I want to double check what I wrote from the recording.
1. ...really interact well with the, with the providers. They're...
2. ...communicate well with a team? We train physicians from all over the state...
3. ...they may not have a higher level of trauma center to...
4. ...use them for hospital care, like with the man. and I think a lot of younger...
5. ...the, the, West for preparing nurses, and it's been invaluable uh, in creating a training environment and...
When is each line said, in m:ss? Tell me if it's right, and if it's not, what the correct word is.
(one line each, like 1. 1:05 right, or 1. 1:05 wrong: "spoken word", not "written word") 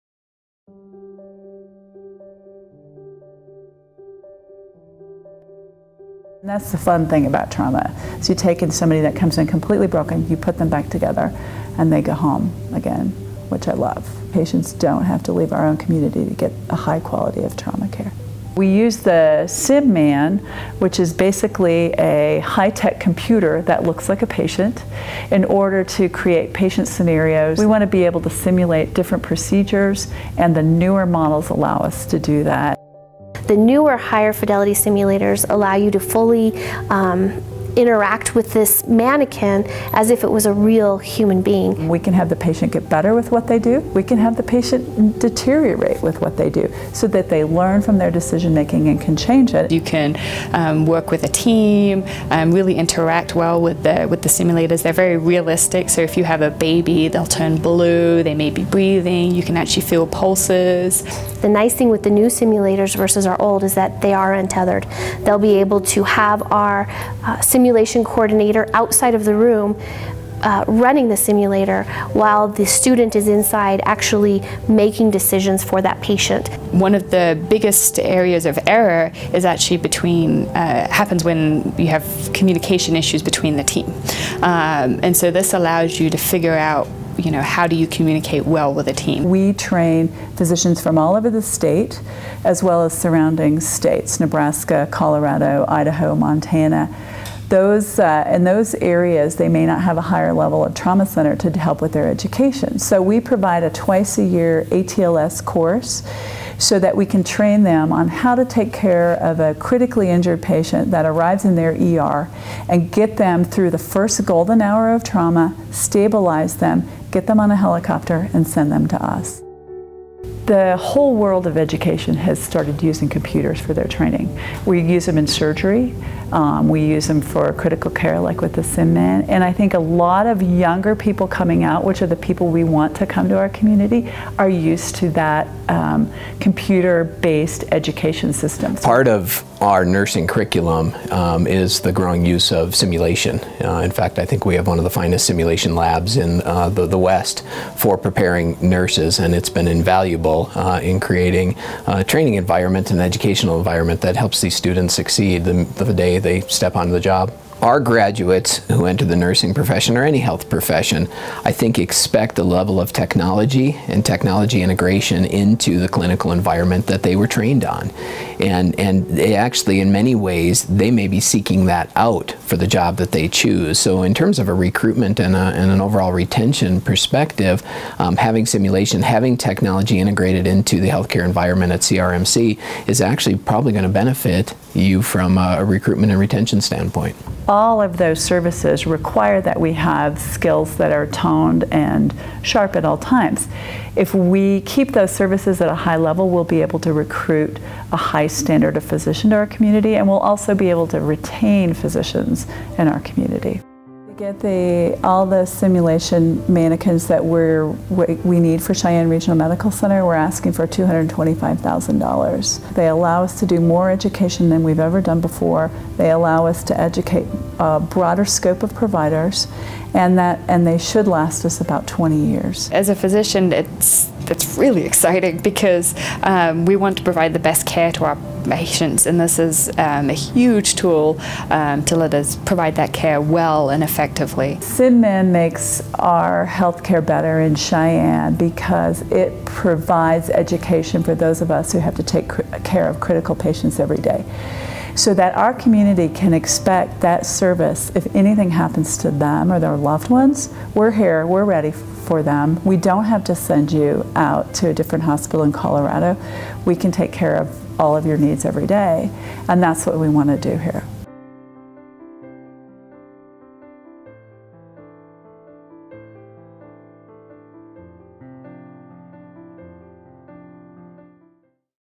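1. 0:52 wrong: "simulators", not "providers"
2. 1:27 right
3. 1:39 right
4. 2:06 wrong: "critical", not "hospital"
5. 2:26 right.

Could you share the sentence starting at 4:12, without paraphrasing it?
We don't have to send you out to a different hospital in Colorado.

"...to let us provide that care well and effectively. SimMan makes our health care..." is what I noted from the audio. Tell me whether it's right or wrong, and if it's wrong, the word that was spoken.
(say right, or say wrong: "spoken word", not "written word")
right.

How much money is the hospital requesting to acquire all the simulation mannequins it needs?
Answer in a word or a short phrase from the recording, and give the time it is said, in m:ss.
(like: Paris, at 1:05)
$225,000, at 3:30.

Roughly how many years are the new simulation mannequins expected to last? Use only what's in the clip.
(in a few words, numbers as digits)
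20 years.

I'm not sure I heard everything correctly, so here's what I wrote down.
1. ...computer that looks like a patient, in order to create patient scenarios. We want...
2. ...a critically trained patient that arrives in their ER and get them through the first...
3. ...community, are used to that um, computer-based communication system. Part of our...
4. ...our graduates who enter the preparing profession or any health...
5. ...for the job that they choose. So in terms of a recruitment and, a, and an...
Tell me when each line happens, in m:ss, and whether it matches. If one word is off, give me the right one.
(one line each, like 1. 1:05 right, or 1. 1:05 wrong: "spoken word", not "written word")
1. 0:22 right
2. 1:49 wrong: "injured", not "trained"
3. 2:13 wrong: "education", not "communication"
4. 2:37 wrong: "nursing", not "preparing"
5. 2:52 right.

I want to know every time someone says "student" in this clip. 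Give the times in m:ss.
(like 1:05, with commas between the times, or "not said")
1:12, 2:34.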